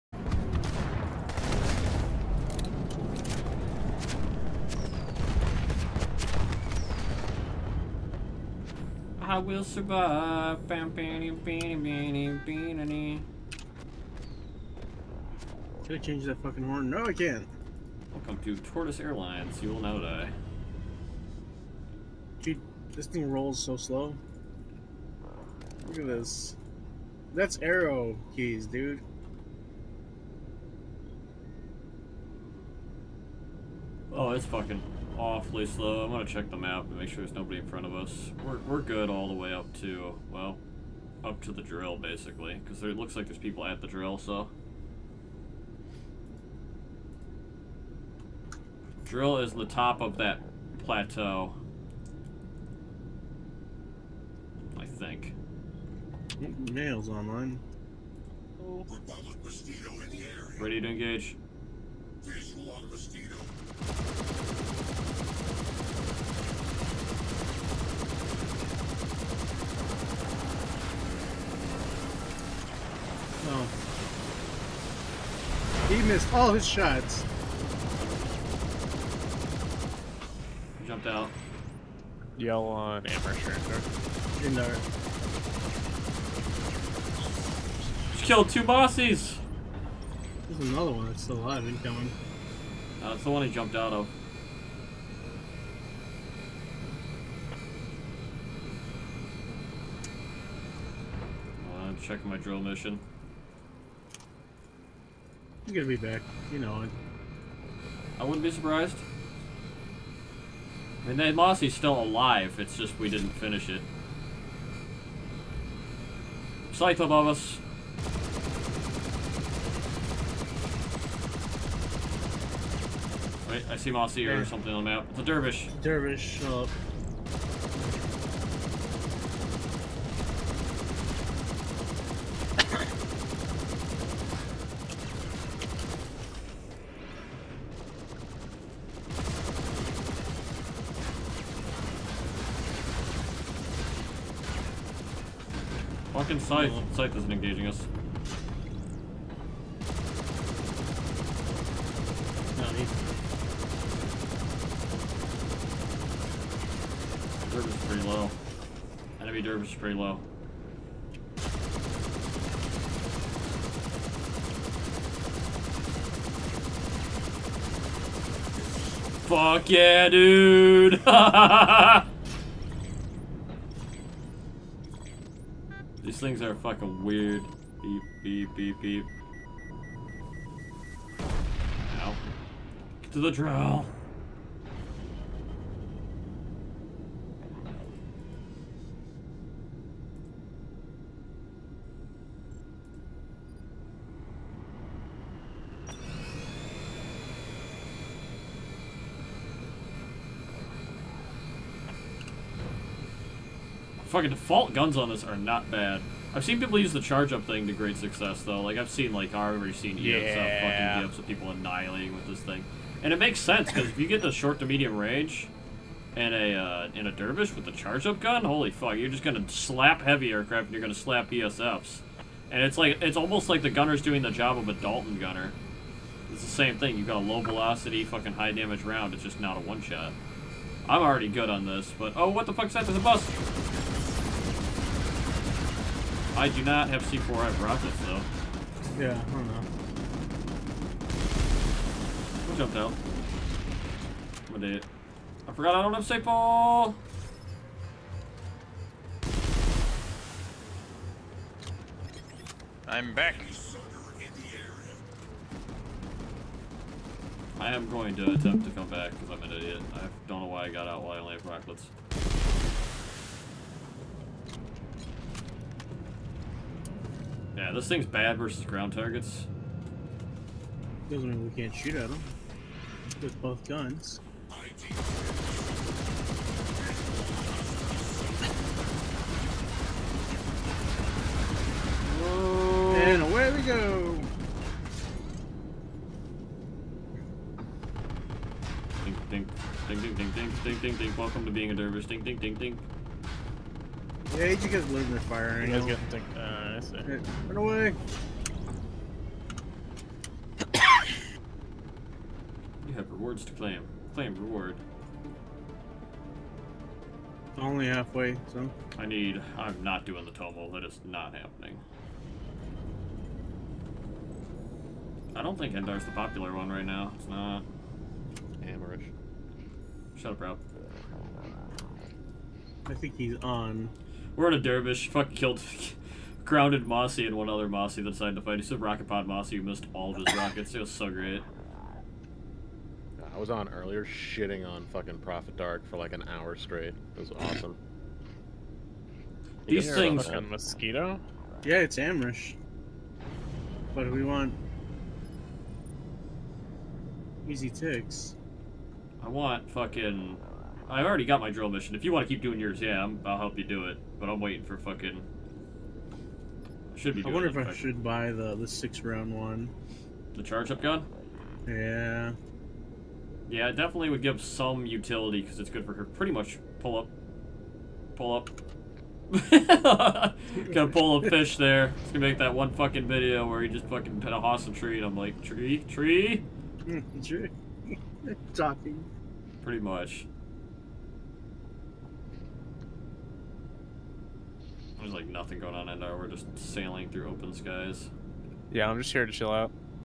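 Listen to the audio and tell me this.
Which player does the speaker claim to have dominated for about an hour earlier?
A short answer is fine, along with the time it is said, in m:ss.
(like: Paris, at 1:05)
Prophet Dark, at 5:35.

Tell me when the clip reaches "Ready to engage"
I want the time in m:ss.
1:00.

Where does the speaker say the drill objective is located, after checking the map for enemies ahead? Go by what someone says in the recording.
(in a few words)
top of that plateau.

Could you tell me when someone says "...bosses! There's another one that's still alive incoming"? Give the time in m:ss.
1:28.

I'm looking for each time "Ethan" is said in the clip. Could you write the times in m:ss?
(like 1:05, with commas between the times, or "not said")
not said.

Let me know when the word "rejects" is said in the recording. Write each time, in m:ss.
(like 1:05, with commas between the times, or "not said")
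not said.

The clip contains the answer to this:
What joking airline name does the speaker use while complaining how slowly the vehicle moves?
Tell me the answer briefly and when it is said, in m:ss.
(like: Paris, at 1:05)
Tortoise Airlines, at 0:18.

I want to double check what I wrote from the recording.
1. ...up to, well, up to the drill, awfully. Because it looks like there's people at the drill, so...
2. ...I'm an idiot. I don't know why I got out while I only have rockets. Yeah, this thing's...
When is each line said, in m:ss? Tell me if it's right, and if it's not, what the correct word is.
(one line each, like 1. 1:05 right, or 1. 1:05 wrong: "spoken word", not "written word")
1. 0:39 wrong: "basically", not "awfully"
2. 4:19 right.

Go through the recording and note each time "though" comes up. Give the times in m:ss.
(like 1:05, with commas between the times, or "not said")
3:28, 3:58.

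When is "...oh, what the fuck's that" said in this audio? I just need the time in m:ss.
3:52.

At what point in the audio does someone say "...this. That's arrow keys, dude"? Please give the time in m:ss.
0:26.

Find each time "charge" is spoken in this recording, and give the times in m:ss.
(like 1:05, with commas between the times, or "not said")
3:27, 3:37, 6:00.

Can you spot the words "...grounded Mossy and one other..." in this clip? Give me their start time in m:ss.
5:26.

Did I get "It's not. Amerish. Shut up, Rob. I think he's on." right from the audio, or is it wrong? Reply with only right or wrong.
right.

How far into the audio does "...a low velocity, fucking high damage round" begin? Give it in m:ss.
3:47.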